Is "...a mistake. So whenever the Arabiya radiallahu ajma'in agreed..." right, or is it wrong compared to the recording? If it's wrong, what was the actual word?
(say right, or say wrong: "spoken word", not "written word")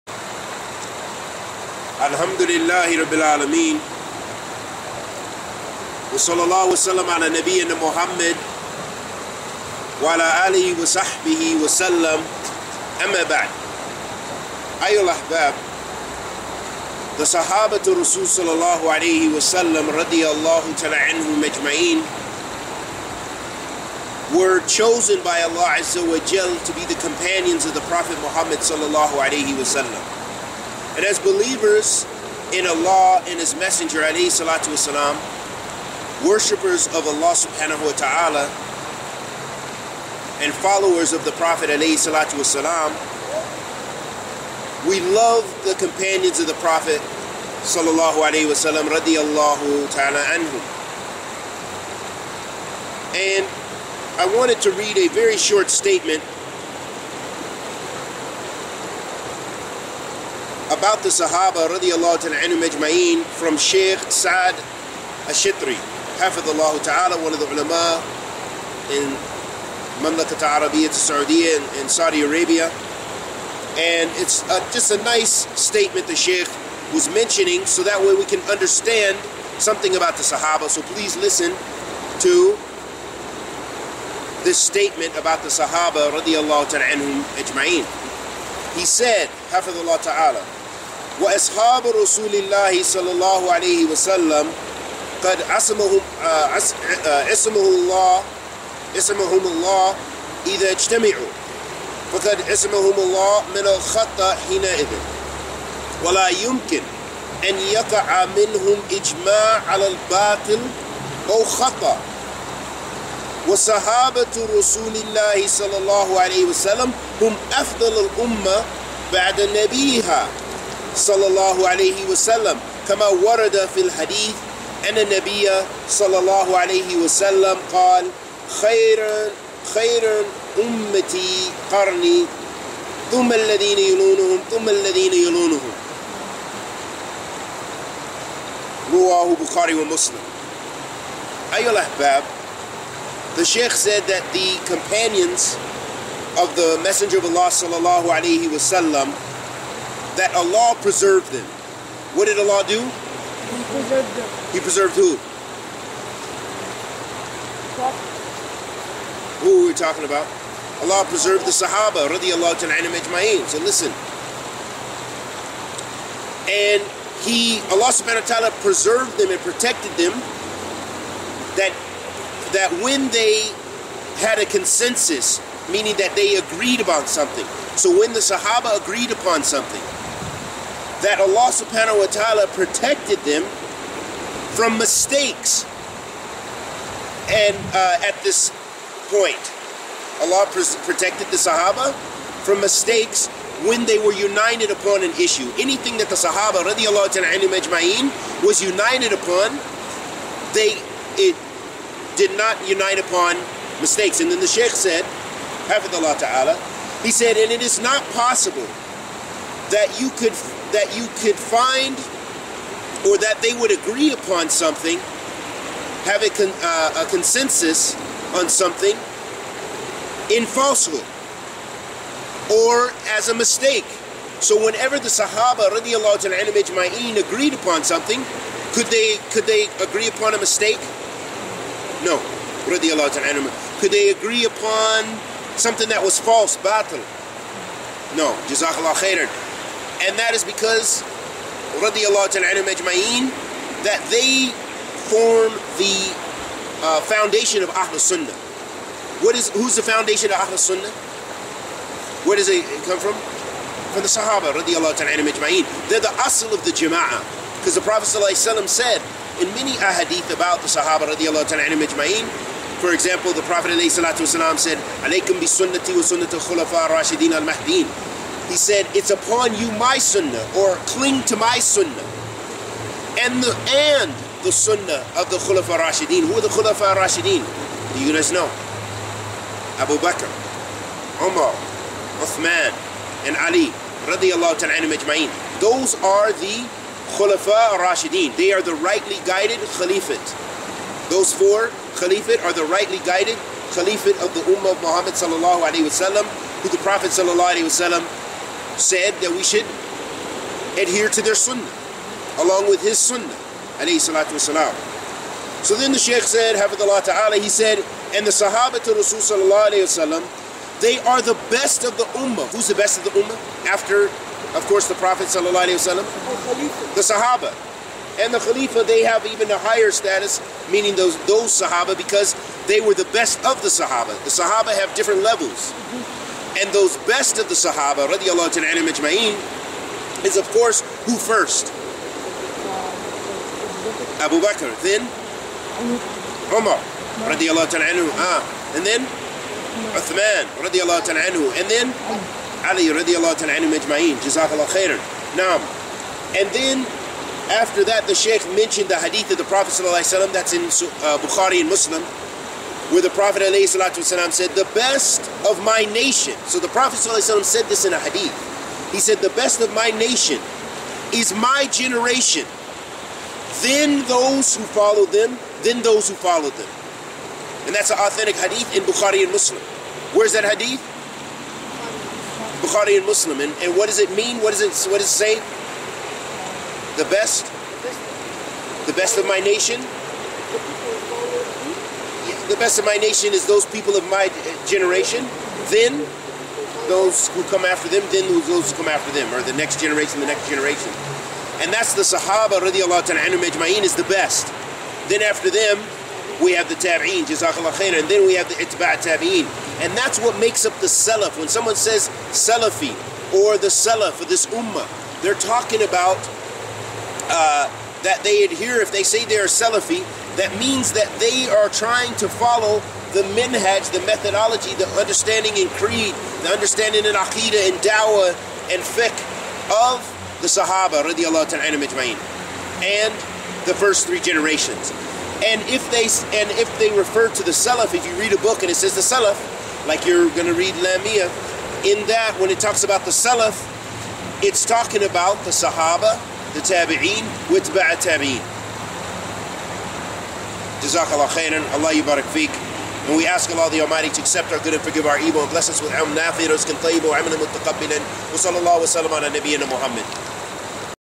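wrong: "Sahaba", not "Arabiya".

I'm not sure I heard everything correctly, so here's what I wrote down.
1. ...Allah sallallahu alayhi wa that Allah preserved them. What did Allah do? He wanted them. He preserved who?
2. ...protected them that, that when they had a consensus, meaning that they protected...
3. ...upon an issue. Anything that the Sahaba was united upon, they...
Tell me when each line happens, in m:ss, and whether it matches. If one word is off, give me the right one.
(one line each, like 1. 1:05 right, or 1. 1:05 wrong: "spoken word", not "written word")
1. 2:27 wrong: "preserved", not "wanted"
2. 2:49 wrong: "agreed", not "protected"
3. 3:14 right.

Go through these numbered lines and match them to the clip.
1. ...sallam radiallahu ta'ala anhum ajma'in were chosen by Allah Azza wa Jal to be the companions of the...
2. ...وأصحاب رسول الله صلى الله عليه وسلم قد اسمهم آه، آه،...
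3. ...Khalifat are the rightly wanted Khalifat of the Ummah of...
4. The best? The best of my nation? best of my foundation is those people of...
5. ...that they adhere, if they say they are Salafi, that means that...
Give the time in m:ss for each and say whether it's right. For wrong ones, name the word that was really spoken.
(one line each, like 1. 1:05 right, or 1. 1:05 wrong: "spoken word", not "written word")
1. 0:19 right
2. 1:31 wrong: "عصمهم", not "اسمهم"
3. 4:51 wrong: "guided", not "wanted"
4. 6:17 wrong: "nation", not "foundation"
5. 6:48 right.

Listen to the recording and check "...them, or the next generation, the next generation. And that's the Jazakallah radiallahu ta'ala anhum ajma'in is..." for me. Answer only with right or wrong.
wrong.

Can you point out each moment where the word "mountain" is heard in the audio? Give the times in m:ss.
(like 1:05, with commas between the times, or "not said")
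not said.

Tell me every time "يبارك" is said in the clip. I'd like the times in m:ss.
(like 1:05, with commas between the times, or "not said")
7:21.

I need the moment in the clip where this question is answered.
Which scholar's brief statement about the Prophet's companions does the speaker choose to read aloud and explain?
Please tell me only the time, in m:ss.
1:03.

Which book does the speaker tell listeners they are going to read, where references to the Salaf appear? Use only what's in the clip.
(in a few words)
Lamia.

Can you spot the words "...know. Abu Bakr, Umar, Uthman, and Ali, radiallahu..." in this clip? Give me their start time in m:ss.
4:38.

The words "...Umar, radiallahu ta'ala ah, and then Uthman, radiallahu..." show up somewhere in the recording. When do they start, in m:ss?
5:36.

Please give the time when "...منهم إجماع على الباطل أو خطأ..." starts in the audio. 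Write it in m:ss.
1:48.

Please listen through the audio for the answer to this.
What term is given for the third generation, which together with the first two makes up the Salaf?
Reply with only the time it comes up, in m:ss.
6:38.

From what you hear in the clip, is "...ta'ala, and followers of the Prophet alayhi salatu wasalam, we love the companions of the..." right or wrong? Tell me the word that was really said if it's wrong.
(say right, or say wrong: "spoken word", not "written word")
right.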